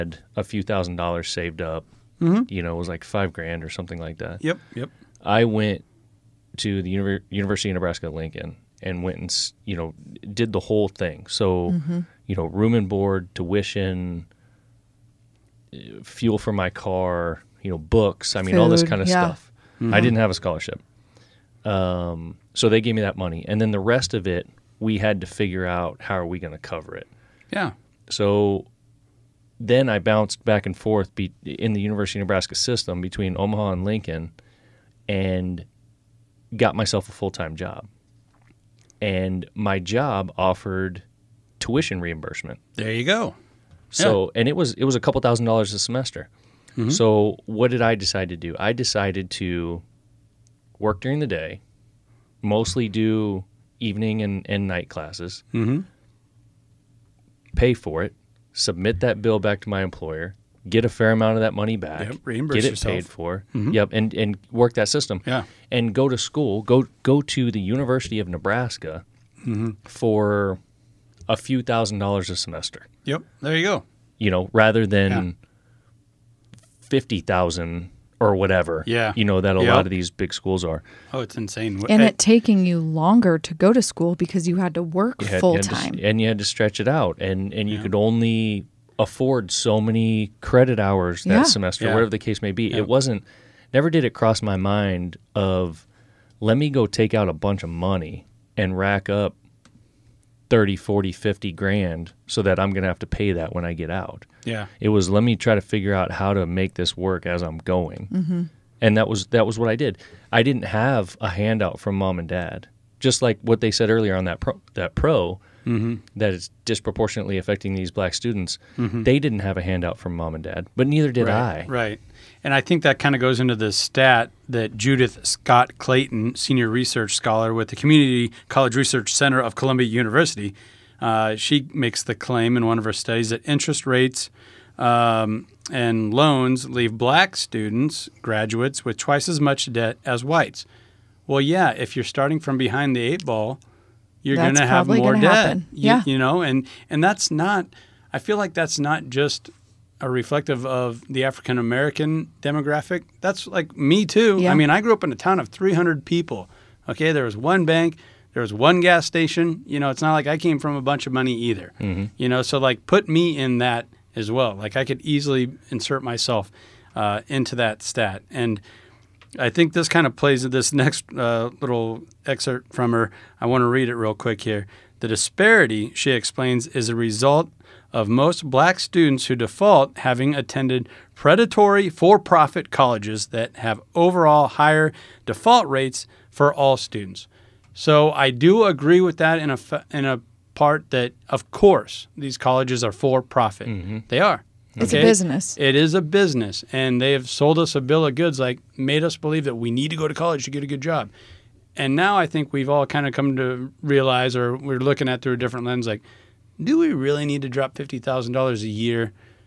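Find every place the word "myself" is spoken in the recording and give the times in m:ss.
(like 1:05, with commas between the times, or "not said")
0:36, 2:46.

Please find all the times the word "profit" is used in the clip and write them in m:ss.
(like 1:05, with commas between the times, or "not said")
3:02, 3:13.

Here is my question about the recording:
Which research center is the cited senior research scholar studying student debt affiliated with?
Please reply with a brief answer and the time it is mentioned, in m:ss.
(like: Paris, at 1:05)
Community College Research Center, at 2:07.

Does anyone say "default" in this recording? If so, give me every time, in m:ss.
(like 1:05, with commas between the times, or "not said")
2:59, 3:05.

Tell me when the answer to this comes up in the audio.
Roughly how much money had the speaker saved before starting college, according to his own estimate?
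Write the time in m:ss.
0:03.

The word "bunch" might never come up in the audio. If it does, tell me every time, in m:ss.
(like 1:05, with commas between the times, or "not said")
1:37, 2:40.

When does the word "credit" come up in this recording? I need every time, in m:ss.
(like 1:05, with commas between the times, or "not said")
1:30.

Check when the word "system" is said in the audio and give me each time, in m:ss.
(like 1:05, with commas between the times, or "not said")
0:32, 1:04.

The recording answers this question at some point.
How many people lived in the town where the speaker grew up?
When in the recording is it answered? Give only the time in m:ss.
2:35.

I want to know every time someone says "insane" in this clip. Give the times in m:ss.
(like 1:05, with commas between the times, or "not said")
1:21.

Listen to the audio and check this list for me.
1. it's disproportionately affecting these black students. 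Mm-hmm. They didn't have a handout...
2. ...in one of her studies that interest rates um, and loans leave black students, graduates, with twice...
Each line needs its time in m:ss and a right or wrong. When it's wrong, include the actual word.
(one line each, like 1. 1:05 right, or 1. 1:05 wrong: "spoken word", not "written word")
1. 1:56 right
2. 2:12 right.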